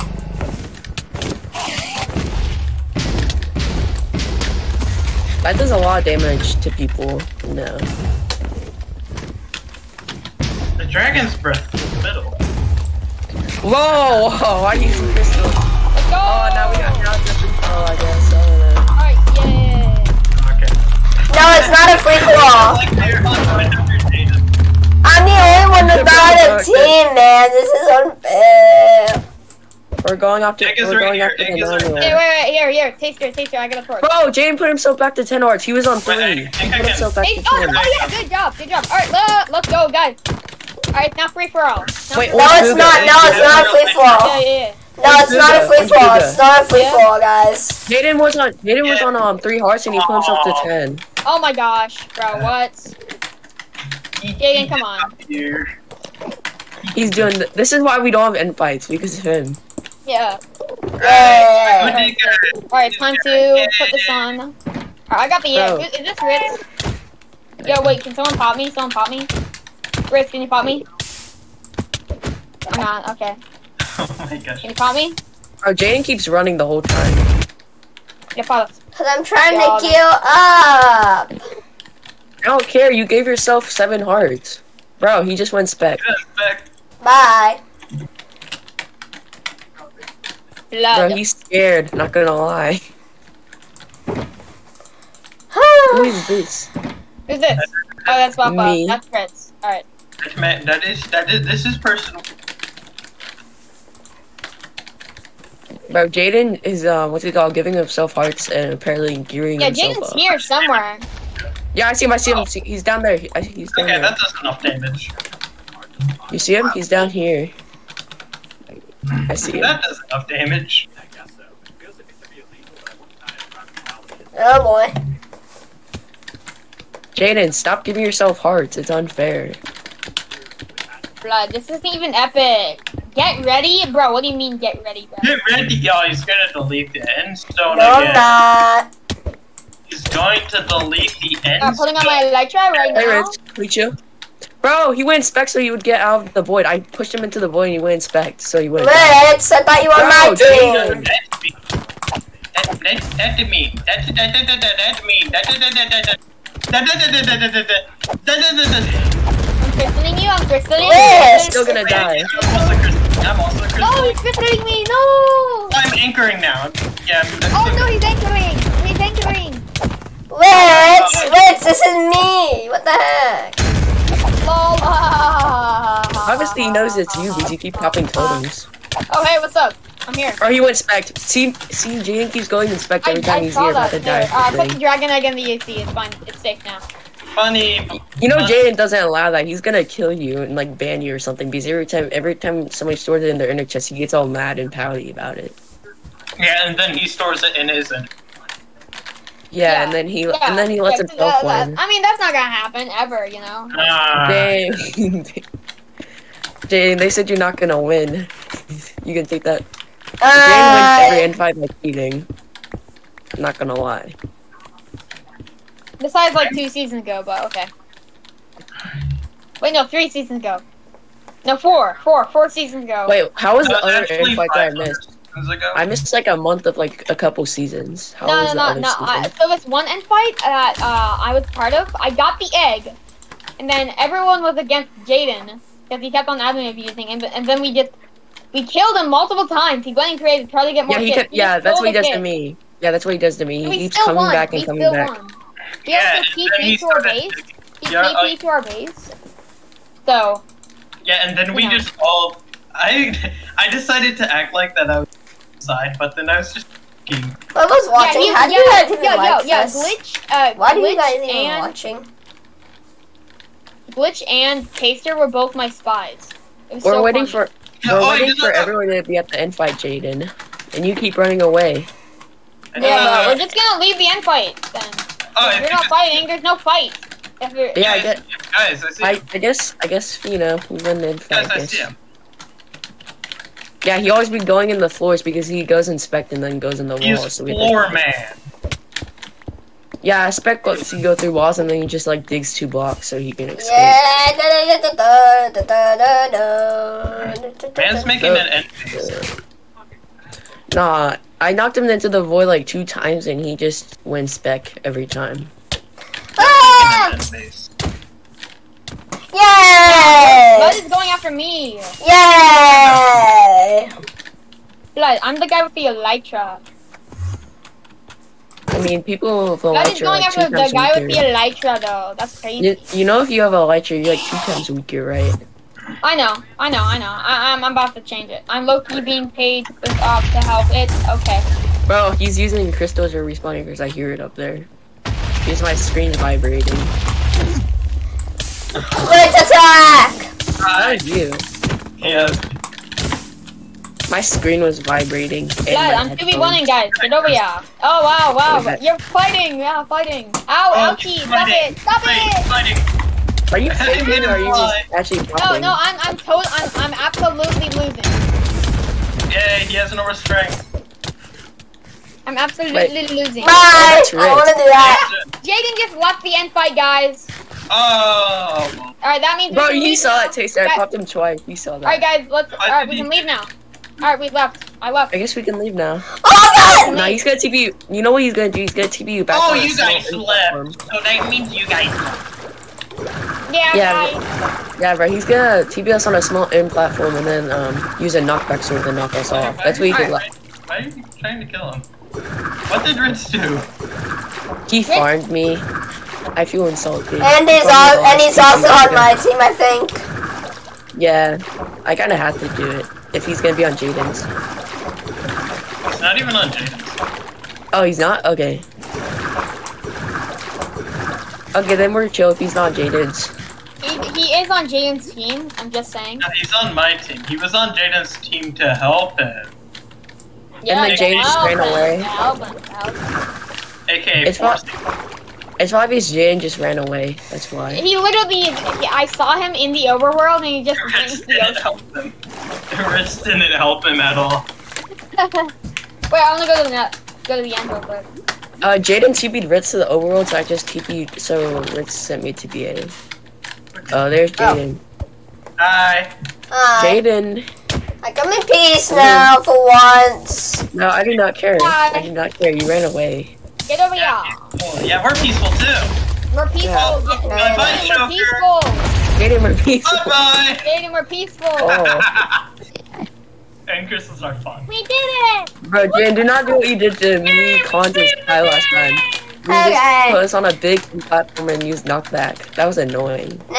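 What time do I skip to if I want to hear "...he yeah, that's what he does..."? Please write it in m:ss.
4:01.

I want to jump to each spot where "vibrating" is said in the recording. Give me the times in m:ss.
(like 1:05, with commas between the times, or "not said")
5:36, 5:44.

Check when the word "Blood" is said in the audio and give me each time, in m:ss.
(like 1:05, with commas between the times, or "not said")
1:30, 2:11, 5:10, 5:14, 5:19.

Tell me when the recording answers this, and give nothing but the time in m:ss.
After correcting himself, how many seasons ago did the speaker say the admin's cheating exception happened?
3:42.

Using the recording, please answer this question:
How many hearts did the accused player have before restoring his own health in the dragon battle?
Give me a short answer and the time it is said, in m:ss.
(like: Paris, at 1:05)
3, at 0:35.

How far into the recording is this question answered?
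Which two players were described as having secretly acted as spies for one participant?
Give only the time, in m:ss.
4:23.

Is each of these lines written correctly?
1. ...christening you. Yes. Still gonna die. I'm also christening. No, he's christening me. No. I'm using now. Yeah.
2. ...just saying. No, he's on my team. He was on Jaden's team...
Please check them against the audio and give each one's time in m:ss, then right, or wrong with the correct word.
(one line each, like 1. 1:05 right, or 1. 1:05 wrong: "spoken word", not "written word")
1. 2:40 wrong: "anchoring", not "using"
2. 6:55 right.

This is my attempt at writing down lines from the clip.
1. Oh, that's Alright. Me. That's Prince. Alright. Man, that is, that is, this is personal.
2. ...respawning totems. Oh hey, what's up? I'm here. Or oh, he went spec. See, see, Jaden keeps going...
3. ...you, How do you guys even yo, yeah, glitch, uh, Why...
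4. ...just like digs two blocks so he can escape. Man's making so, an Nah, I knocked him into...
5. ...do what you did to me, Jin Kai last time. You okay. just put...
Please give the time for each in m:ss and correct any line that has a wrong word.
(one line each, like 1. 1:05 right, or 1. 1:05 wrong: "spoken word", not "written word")
1. 1:38 wrong: "Papa", not "Alright"
2. 2:57 wrong: "popping", not "respawning"
3. 4:18 right
4. 4:51 right
5. 7:46 wrong: "Contest", not "Jin".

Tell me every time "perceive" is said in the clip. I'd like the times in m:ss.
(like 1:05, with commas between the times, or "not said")
not said.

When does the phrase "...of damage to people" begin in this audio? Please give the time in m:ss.
0:05.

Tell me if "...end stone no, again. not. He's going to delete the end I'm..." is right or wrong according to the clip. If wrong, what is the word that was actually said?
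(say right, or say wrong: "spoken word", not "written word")
right.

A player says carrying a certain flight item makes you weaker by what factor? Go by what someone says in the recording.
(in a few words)
2.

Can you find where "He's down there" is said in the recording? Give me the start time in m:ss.
1:52.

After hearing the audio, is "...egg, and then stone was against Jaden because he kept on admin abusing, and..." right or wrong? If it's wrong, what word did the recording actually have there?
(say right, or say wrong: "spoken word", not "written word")
wrong: "everyone", not "stone".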